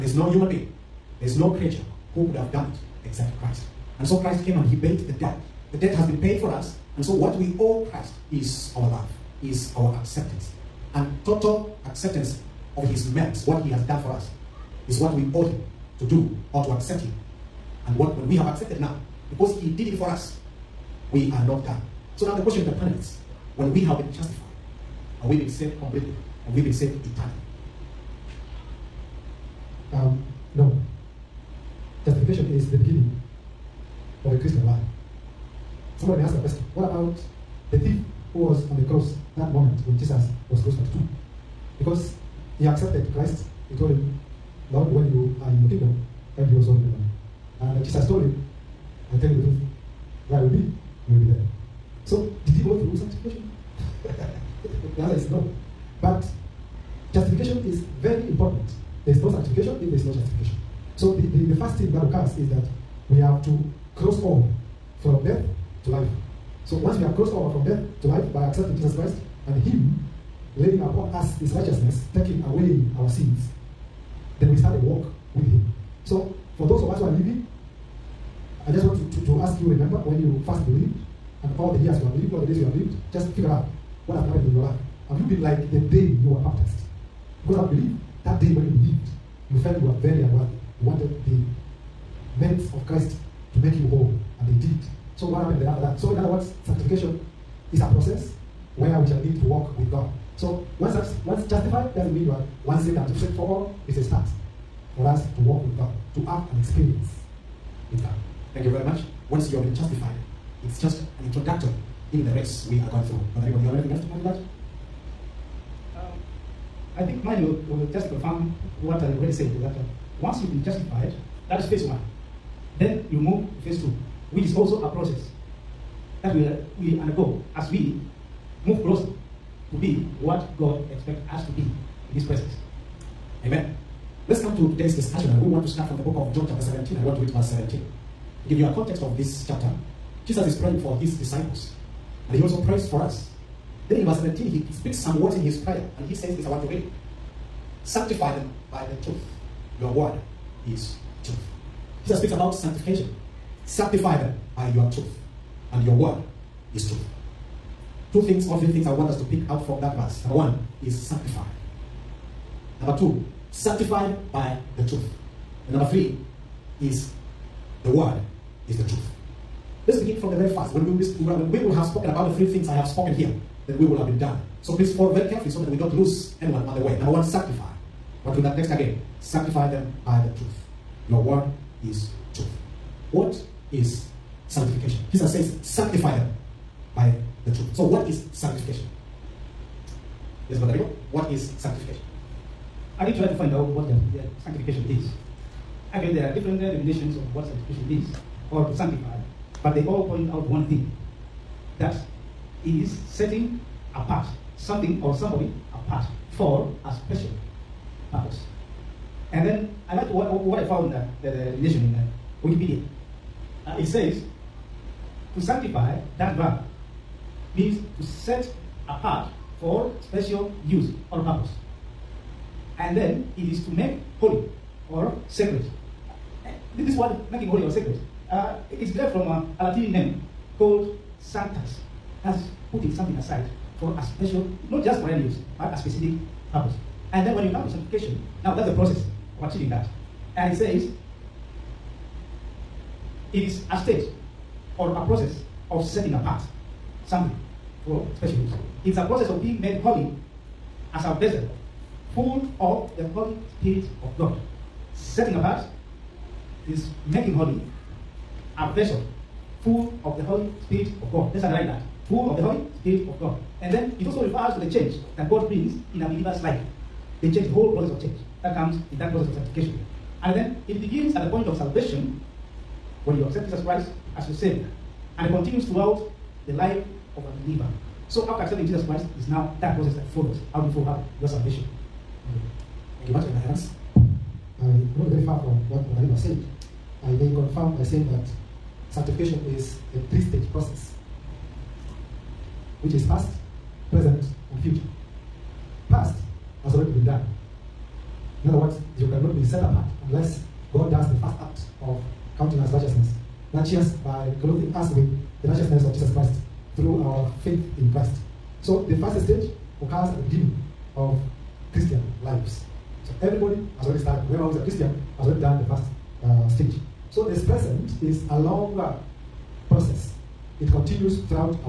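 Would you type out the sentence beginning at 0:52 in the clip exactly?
So, did you go through sanctification?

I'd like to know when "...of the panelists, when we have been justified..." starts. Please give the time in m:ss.
0:22.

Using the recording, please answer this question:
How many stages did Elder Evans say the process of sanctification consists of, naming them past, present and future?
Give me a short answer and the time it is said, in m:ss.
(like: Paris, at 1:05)
3, at 4:50.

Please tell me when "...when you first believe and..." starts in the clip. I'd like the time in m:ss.
1:20.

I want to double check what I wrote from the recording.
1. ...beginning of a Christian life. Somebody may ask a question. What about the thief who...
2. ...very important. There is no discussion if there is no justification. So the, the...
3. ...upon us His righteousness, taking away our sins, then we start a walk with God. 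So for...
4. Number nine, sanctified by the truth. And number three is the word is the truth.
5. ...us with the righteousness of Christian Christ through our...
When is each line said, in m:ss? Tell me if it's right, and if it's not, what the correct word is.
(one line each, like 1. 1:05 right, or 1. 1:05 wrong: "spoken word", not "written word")
1. 0:32 right
2. 0:58 wrong: "sanctification", not "discussion"
3. 1:10 wrong: "Him", not "God"
4. 2:42 wrong: "two", not "nine"
5. 5:04 wrong: "Jesus", not "Christian".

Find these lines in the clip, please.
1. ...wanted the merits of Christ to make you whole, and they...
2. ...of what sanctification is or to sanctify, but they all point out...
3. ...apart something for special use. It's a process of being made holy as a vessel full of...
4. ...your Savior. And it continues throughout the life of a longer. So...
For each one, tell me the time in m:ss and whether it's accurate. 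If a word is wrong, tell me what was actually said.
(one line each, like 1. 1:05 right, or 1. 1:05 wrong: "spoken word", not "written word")
1. 1:30 right
2. 3:17 right
3. 4:06 right
4. 4:34 wrong: "believer", not "longer".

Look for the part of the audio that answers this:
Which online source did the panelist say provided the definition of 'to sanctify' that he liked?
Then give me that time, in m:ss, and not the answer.
3:32.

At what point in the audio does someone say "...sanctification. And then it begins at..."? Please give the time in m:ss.
4:29.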